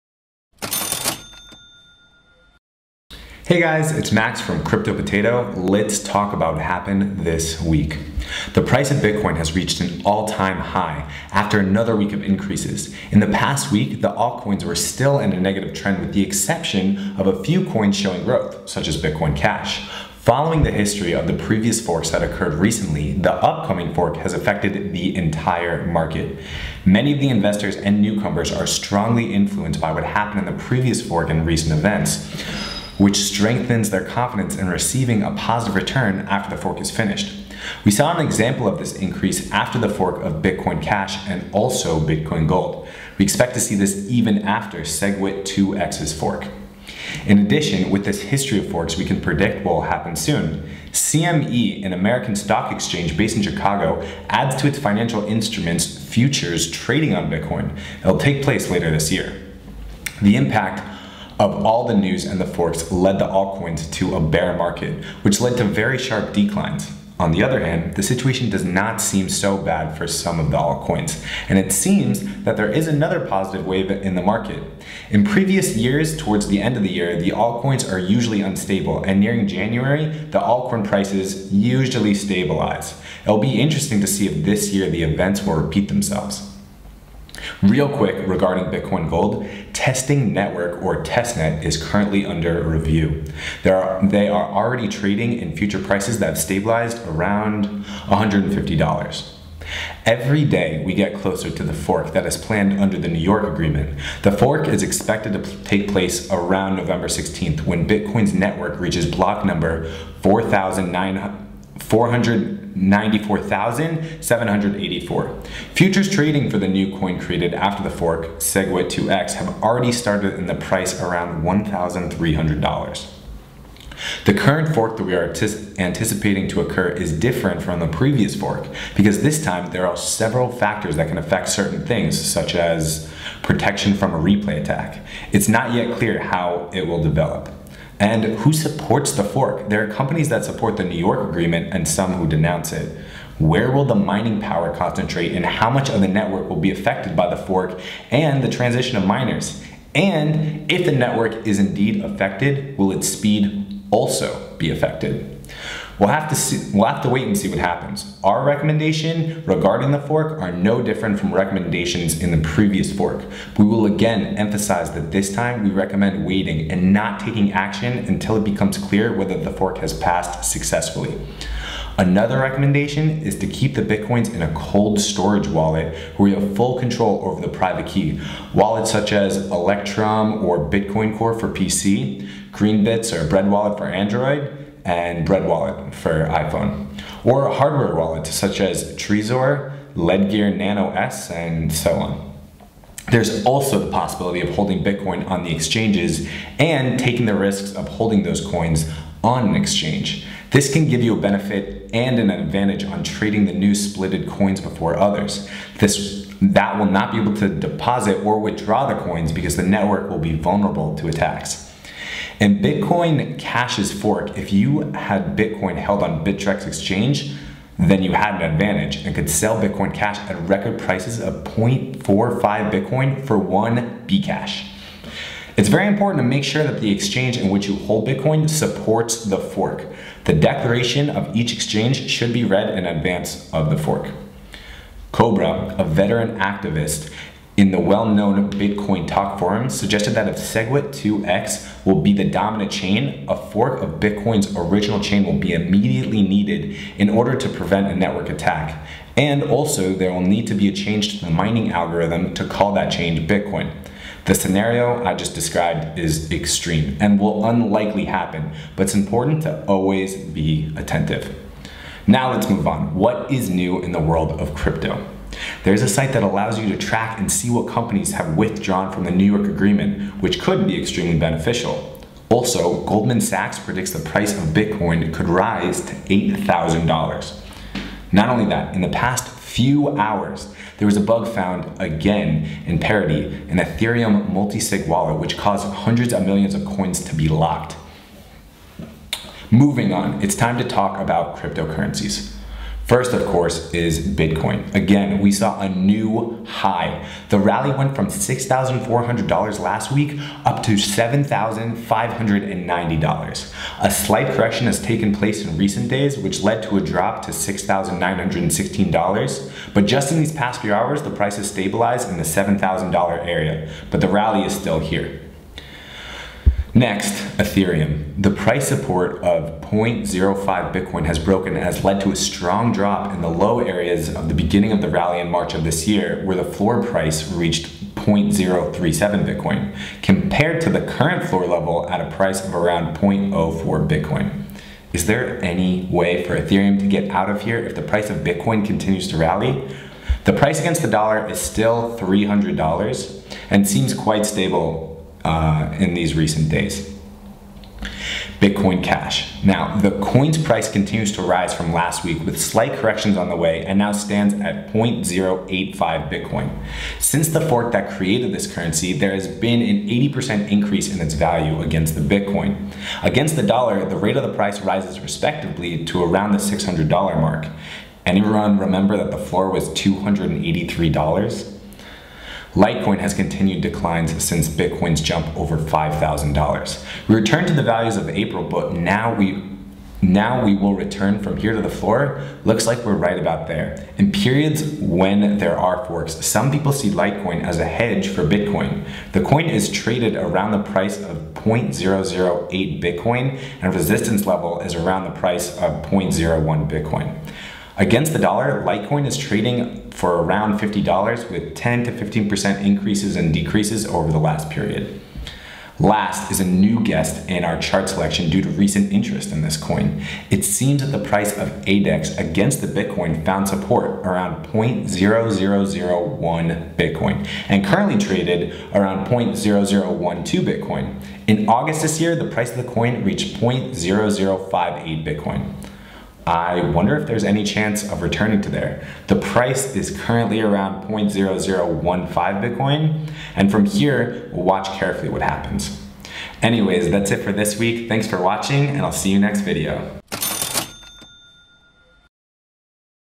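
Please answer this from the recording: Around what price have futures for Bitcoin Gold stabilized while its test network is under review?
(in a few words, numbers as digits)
$150.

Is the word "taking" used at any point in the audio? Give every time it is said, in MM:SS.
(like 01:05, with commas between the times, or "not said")
02:47, 03:16.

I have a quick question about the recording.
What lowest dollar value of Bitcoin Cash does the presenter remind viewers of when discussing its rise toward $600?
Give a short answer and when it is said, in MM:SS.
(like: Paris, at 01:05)
$283, at 06:09.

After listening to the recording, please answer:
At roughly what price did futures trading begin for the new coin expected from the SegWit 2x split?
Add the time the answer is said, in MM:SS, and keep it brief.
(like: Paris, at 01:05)
$1,300, at 02:01.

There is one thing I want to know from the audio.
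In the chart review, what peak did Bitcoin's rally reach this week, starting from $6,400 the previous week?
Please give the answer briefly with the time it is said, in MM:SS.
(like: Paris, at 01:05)
$7,590, at 05:00.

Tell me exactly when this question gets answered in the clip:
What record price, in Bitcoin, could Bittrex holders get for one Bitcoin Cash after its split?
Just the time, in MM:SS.
03:41.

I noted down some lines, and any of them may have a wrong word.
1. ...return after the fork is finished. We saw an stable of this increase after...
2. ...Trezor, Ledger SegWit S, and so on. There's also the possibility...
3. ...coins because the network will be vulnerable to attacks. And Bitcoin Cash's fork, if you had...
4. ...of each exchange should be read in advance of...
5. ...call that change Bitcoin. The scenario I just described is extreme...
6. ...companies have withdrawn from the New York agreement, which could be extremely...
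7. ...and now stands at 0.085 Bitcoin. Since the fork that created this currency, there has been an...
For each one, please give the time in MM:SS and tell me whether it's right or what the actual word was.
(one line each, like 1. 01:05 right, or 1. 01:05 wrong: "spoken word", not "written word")
1. 00:35 wrong: "example", not "stable"
2. 03:08 wrong: "Nano", not "SegWit"
3. 03:28 right
4. 03:51 right
5. 04:12 right
6. 04:27 right
7. 05:53 right.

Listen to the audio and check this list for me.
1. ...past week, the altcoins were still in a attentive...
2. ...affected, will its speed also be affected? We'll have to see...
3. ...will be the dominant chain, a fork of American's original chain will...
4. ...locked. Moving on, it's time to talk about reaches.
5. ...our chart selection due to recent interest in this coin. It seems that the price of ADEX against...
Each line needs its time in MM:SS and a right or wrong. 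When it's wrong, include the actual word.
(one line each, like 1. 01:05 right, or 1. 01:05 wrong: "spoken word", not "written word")
1. 00:13 wrong: "negative", not "attentive"
2. 02:32 right
3. 04:01 wrong: "Bitcoin", not "American"
4. 04:47 wrong: "cryptocurrencies", not "reaches"
5. 06:47 right.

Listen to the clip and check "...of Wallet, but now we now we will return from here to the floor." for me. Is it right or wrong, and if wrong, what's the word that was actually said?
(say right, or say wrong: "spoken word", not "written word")
wrong: "April", not "Wallet".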